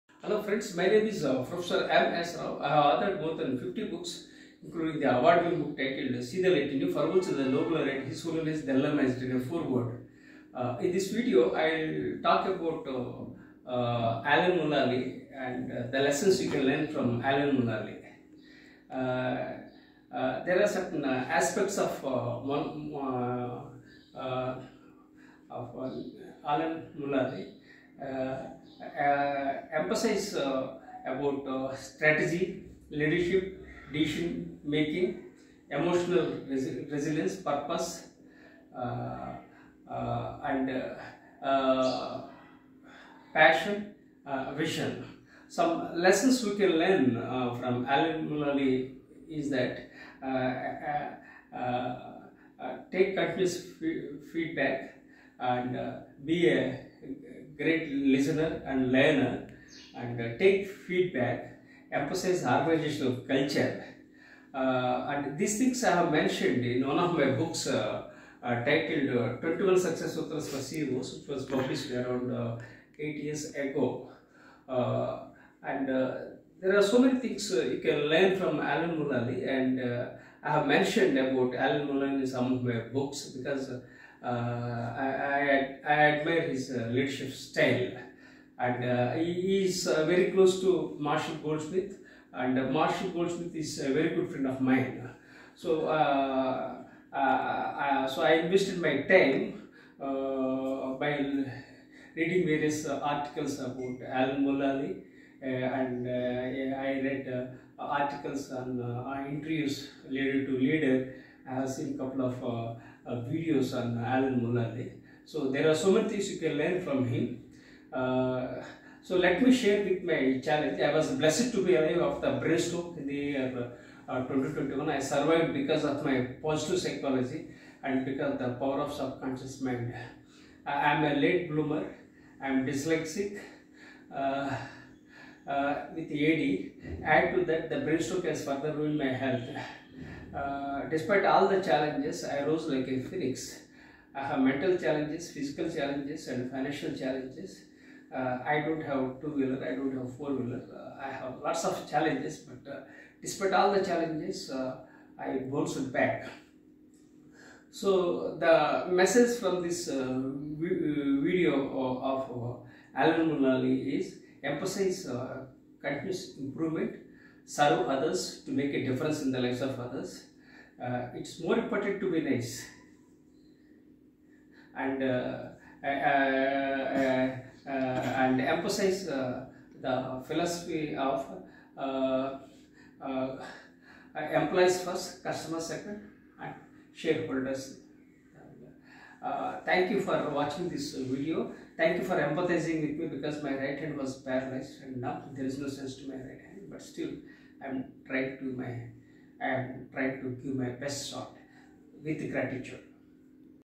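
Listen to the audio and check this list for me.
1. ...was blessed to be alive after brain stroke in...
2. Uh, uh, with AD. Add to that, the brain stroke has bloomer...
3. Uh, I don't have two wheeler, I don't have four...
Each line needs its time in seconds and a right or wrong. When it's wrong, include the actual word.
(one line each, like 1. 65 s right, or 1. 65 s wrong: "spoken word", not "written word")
1. 120 s right
2. 134 s wrong: "further", not "bloomer"
3. 148 s right.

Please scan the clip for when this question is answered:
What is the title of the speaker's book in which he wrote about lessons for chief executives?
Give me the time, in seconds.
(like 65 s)
69 s.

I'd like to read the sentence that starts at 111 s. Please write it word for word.
I have seen a couple of uh, videos on Alan Mulally.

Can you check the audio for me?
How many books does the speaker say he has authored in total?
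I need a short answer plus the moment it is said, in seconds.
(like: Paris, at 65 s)
More than 50, at 3 s.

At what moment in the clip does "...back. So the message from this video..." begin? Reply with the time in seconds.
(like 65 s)
155 s.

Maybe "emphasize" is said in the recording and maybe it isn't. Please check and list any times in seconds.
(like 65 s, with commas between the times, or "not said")
29 s, 61 s, 164 s, 178 s.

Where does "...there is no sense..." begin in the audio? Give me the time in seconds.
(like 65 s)
195 s.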